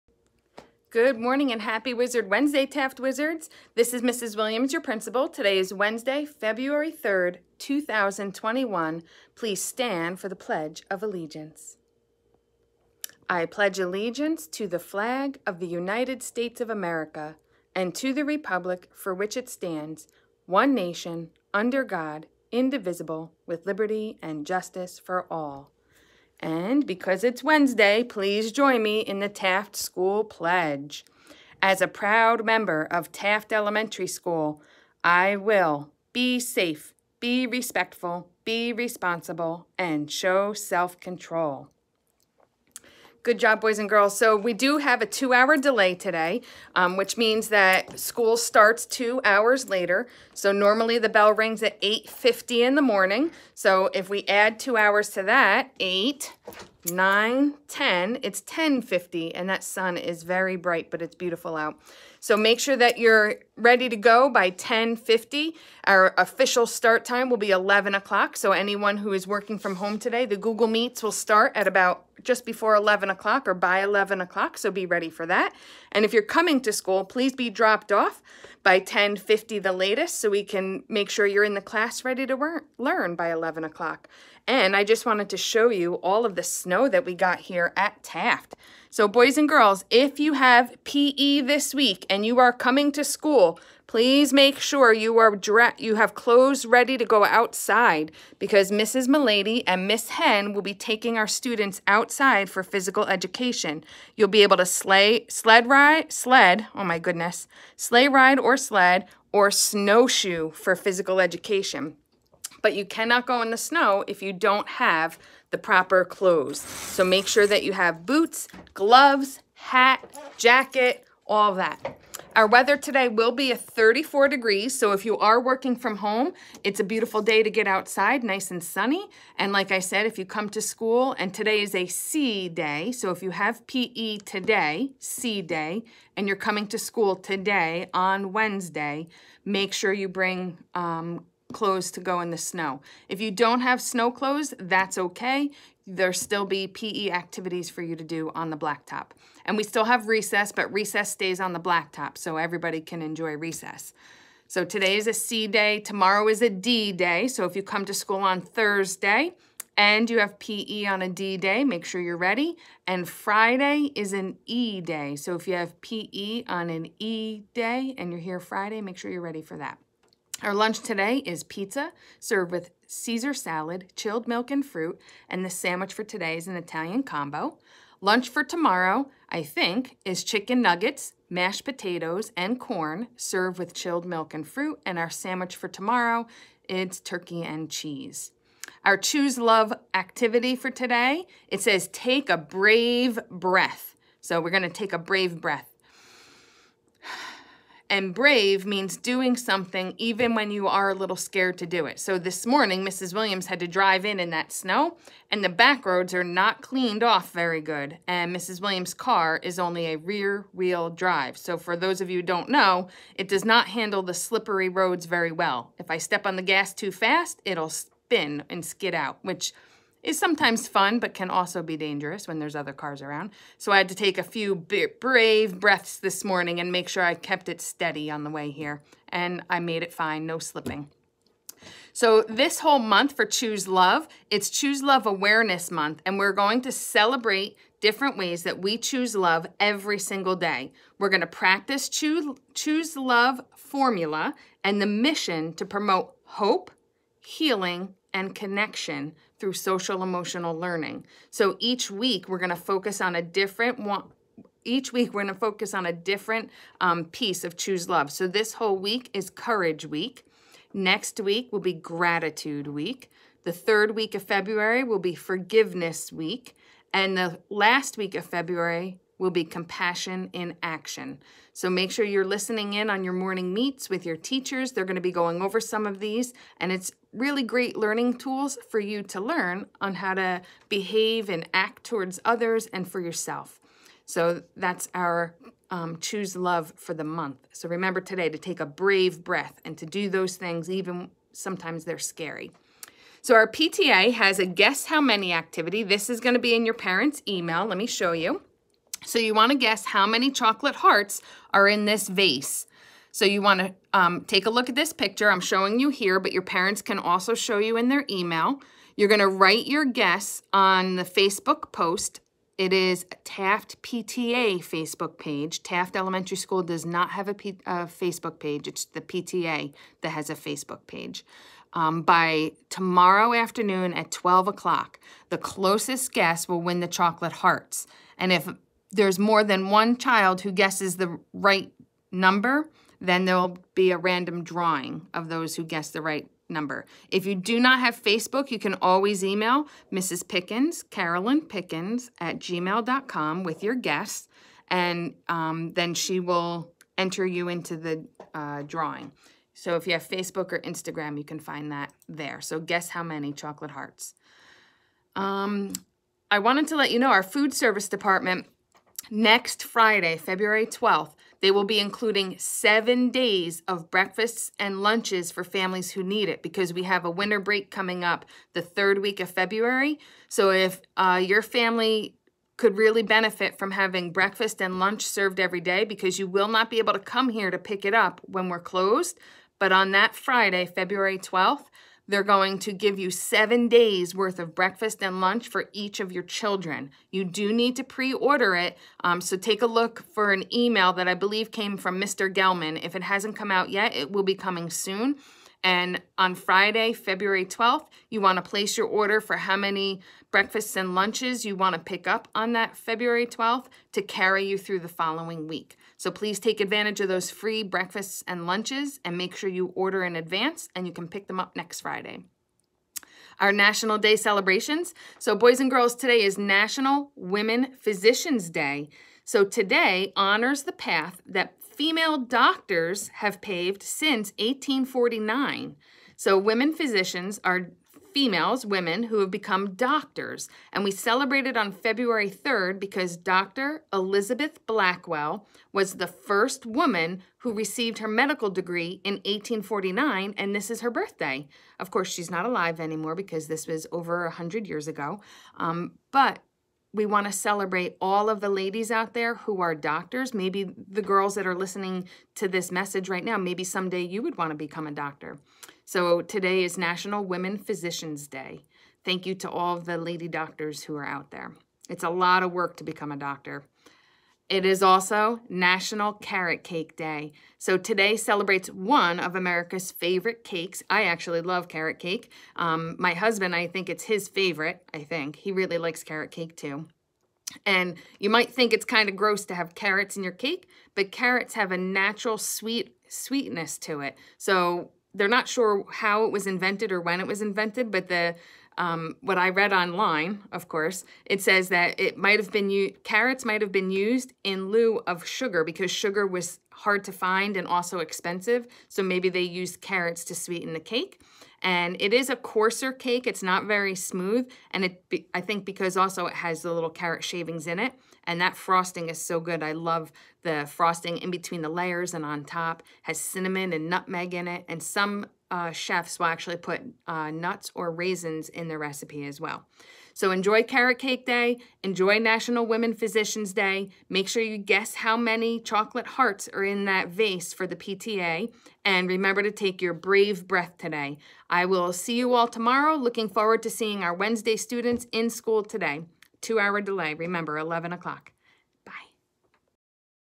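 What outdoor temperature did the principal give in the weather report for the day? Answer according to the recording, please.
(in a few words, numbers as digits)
34 degrees.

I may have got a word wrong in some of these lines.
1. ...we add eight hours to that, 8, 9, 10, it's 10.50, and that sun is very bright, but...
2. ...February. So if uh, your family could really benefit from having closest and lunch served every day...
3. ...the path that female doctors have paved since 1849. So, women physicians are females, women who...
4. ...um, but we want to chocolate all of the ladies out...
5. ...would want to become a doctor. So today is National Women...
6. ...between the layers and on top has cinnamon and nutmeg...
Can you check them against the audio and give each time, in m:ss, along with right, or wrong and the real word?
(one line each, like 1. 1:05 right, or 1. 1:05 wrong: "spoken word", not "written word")
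1. 0:54 wrong: "two", not "eight"
2. 6:09 wrong: "breakfast", not "closest"
3. 7:00 right
4. 7:25 wrong: "celebrate", not "chocolate"
5. 7:34 right
6. 8:31 right.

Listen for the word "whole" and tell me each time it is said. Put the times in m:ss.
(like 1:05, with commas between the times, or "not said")
3:52, 4:18.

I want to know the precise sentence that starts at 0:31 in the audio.
As a proud member of Taft Elementary School, I will be safe, be respectful, be responsible, and show self-control.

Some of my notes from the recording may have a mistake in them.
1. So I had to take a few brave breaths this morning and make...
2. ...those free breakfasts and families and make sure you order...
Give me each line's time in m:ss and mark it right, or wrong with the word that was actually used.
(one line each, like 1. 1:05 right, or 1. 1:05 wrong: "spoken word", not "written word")
1. 3:43 right
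2. 6:47 wrong: "lunches", not "families".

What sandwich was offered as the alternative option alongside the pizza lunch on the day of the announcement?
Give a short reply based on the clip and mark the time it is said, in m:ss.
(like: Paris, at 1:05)
Italian combo, at 2:56.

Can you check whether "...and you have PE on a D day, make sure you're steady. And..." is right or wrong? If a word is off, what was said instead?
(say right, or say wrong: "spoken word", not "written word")
wrong: "ready", not "steady".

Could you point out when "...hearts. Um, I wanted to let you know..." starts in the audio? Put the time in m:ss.
5:53.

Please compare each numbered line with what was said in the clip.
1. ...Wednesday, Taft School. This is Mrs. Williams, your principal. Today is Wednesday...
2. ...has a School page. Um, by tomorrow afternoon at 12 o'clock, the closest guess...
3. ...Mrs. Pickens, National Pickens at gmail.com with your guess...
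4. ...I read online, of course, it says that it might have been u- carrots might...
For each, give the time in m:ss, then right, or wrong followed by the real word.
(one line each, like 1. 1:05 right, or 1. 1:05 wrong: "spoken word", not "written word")
1. 0:02 wrong: "Wizards", not "School"
2. 5:20 wrong: "Facebook", not "School"
3. 5:39 wrong: "Carolyn", not "National"
4. 8:09 right.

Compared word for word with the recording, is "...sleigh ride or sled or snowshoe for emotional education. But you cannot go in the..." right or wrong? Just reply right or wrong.
wrong.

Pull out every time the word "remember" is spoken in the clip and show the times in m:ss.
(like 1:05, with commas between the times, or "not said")
4:47, 8:49, 8:57.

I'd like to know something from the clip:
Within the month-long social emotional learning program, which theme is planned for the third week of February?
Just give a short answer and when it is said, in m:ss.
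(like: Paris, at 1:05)
Forgiveness Week, at 4:25.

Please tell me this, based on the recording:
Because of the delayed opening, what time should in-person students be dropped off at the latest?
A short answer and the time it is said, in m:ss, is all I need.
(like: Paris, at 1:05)
10:50, at 1:18.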